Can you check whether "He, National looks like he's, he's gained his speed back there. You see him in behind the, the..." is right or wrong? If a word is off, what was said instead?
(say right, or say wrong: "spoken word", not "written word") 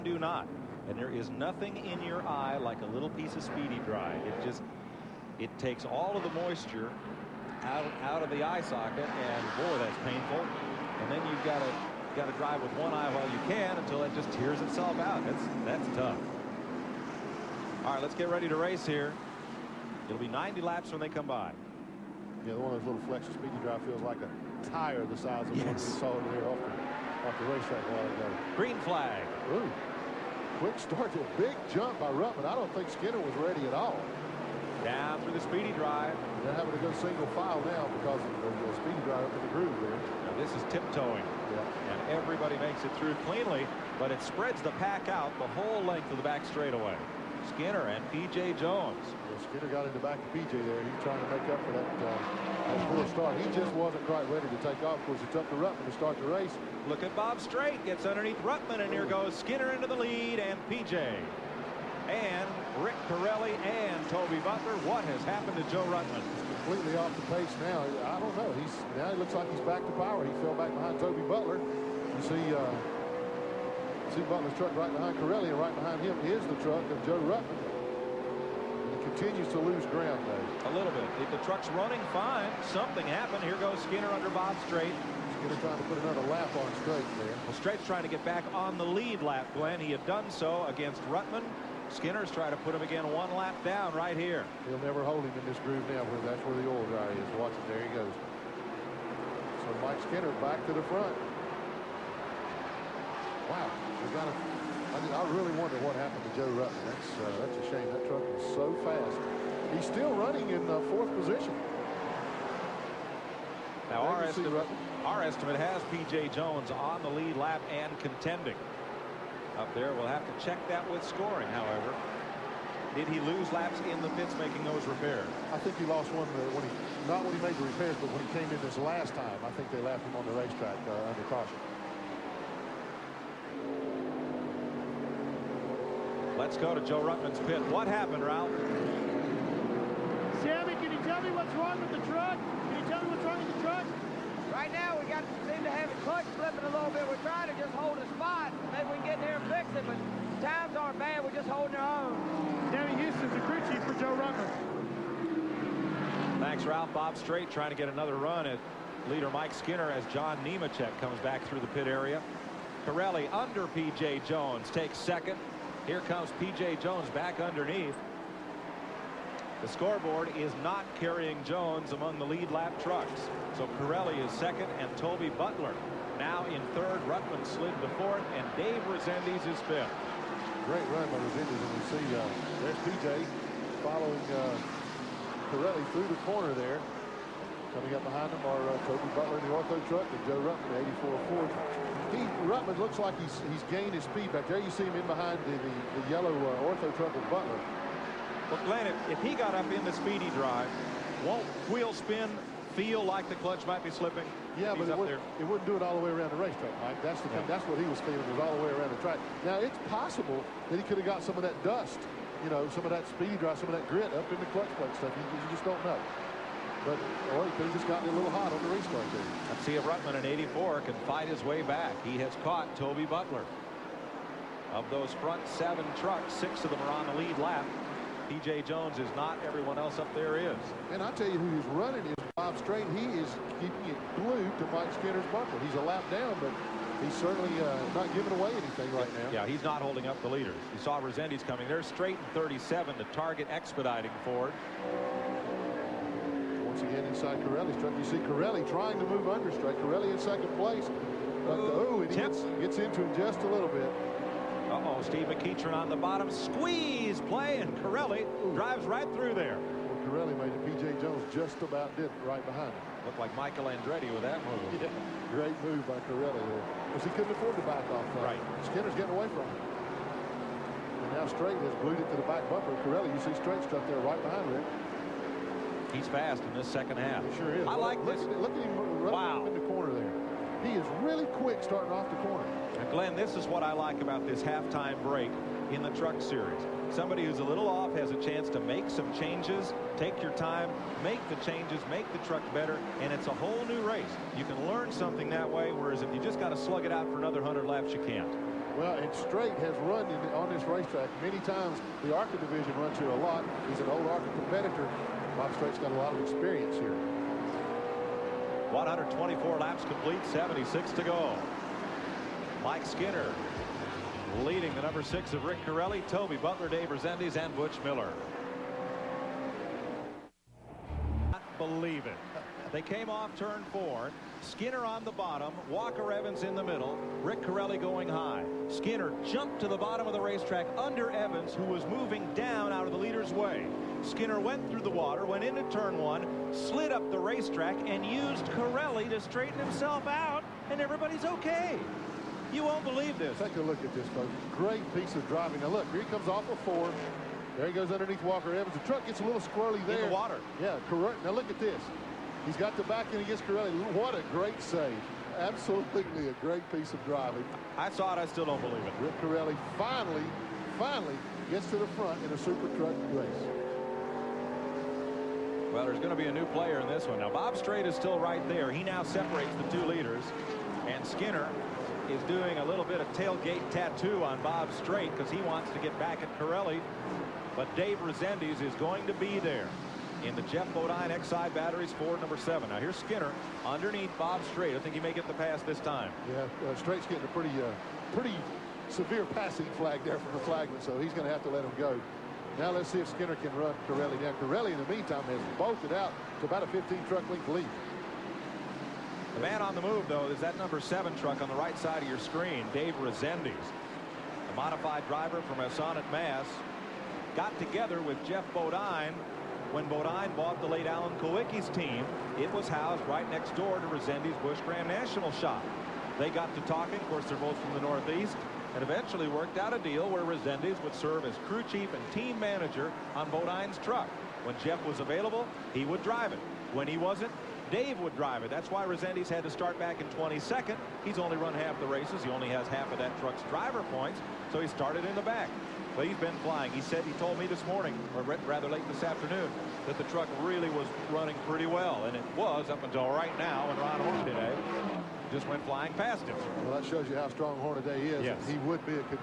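wrong: "Ruttman", not "National".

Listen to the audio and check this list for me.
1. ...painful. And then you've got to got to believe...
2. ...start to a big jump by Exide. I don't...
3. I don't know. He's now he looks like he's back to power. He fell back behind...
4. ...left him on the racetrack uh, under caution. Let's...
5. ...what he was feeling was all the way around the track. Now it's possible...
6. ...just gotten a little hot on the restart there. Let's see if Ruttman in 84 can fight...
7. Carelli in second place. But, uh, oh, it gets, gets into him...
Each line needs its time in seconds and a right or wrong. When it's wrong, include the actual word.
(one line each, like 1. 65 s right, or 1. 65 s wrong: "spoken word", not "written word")
1. 10 s wrong: "drive", not "believe"
2. 30 s wrong: "Ruttman", not "Exide"
3. 68 s right
4. 129 s right
5. 207 s right
6. 217 s right
7. 249 s right.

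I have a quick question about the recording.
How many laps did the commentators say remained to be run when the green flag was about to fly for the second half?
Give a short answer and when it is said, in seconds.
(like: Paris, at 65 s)
90, at 20 s.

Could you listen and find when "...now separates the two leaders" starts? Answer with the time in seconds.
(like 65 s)
368 s.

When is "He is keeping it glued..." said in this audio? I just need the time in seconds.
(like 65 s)
232 s.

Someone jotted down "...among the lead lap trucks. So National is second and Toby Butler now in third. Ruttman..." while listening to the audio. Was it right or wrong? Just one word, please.
wrong.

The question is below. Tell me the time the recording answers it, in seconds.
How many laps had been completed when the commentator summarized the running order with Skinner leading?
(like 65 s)
308 s.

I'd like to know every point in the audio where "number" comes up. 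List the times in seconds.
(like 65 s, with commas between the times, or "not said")
314 s, 382 s, 400 s.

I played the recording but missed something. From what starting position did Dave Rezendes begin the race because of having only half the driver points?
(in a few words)
22nd.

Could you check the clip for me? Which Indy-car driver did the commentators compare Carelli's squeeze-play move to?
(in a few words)
Michael Andretti.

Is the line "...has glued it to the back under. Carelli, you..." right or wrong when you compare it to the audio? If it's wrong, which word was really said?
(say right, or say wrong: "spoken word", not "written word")
wrong: "bumper", not "under".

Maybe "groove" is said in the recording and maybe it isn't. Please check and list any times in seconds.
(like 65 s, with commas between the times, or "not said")
39 s, 95 s.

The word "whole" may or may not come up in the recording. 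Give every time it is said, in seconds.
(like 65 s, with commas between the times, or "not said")
45 s, 293 s.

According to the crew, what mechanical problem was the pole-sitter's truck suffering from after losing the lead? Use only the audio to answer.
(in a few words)
Clutch slipping.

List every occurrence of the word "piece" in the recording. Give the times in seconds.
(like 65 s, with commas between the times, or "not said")
3 s, 344 s, 356 s.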